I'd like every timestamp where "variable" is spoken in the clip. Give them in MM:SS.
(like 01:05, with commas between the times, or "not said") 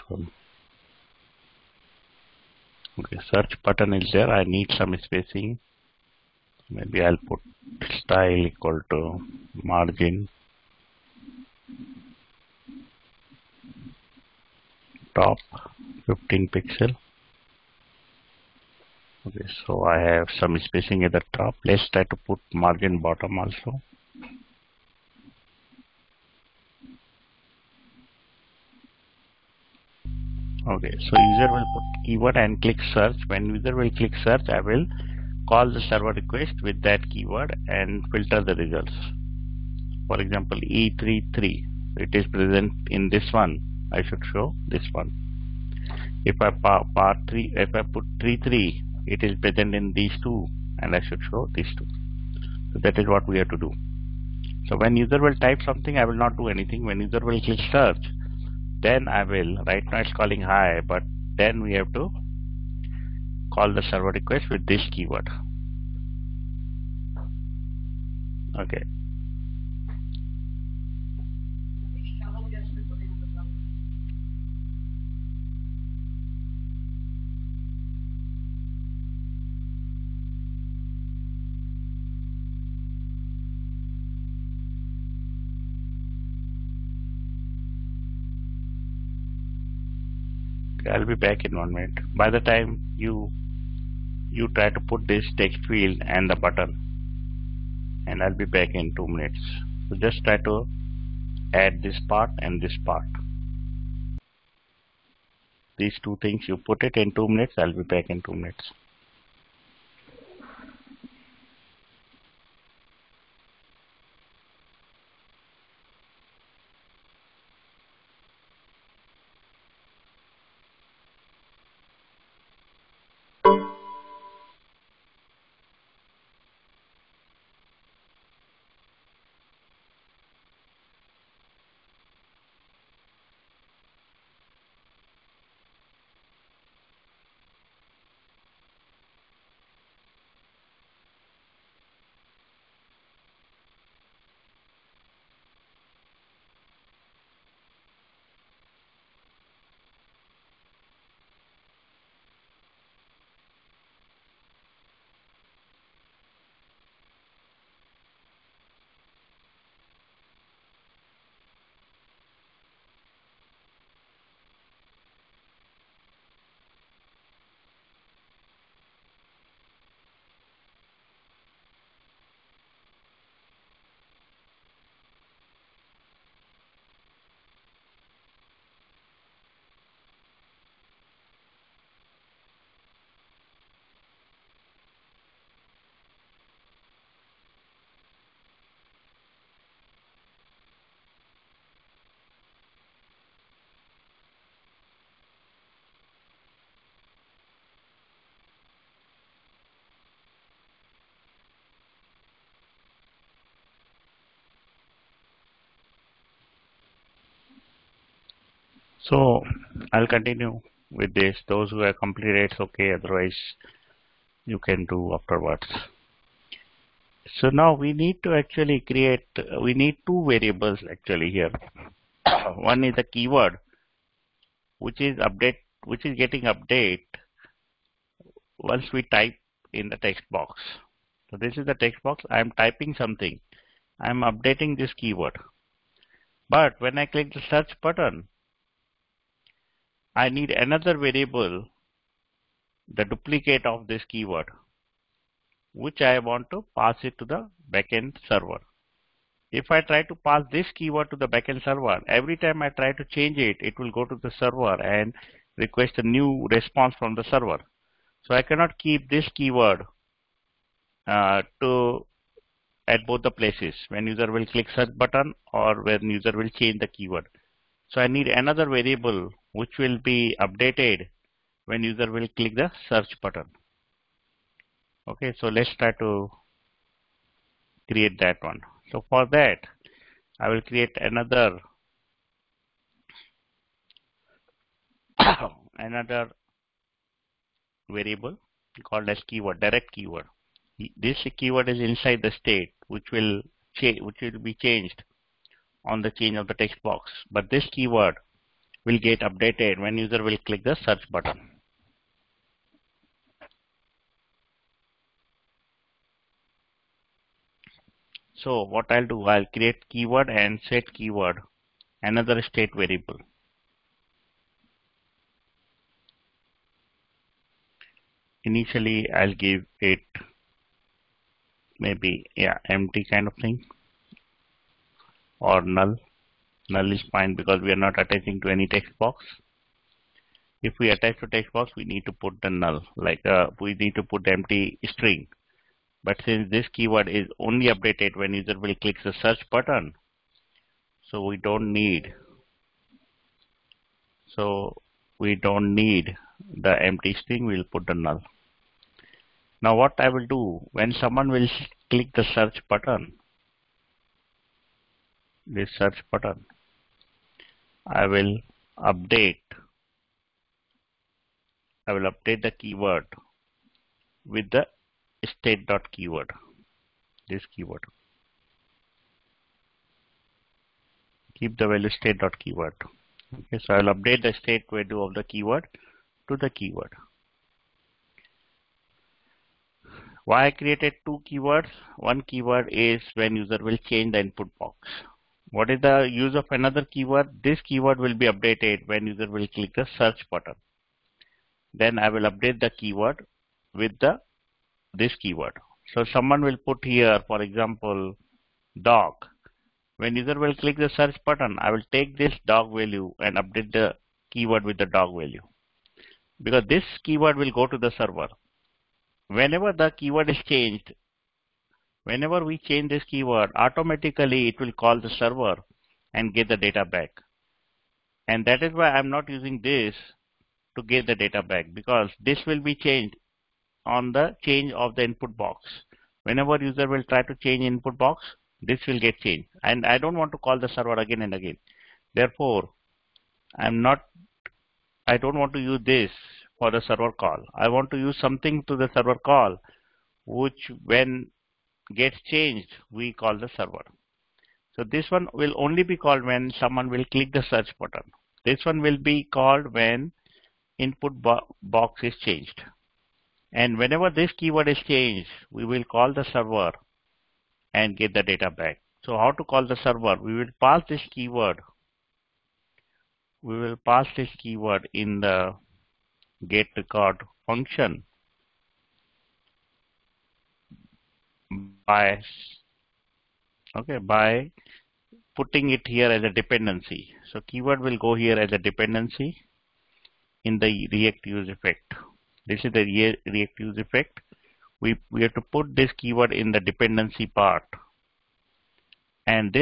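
03:40, 04:00, 04:28, 04:47, 05:12.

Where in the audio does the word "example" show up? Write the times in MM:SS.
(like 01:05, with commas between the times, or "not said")
00:40, 06:37.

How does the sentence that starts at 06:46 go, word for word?
Because this keyword will go to the server.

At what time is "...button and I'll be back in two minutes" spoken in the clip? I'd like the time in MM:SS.
01:36.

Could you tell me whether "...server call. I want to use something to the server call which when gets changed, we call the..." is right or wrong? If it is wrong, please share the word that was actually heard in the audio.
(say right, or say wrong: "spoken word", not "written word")
right.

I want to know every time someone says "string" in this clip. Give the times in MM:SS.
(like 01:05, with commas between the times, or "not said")
05:34, 05:47.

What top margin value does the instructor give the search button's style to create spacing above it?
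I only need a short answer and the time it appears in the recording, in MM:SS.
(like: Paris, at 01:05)
15 pixels, at 00:16.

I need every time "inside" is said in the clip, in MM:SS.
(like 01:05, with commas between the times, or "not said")
04:51.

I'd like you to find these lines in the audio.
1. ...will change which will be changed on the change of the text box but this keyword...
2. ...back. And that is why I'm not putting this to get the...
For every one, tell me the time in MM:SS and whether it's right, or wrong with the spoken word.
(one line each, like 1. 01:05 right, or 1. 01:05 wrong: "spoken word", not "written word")
1. 04:53 right
2. 06:56 wrong: "using", not "putting".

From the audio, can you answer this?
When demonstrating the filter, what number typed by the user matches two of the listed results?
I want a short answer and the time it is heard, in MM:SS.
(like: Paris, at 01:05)
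33, at 00:48.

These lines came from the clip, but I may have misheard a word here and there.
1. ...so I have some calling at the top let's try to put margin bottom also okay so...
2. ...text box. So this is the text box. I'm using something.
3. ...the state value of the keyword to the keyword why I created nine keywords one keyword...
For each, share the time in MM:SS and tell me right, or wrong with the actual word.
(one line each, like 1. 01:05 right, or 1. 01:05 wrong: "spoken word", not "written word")
1. 00:19 wrong: "spacing", not "calling"
2. 03:49 wrong: "typing", not "using"
3. 06:14 wrong: "two", not "nine".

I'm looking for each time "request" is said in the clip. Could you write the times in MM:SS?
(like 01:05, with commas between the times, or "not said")
00:36, 01:04, 04:15.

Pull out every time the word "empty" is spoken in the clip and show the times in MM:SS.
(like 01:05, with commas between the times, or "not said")
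05:22, 05:34, 05:46.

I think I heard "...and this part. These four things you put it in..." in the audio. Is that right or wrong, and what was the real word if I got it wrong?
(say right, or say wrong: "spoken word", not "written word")
wrong: "two", not "four".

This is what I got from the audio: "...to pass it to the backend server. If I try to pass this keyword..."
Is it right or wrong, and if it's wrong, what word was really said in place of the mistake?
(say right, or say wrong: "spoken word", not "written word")
right.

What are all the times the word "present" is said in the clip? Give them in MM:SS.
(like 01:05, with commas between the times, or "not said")
00:42, 00:49.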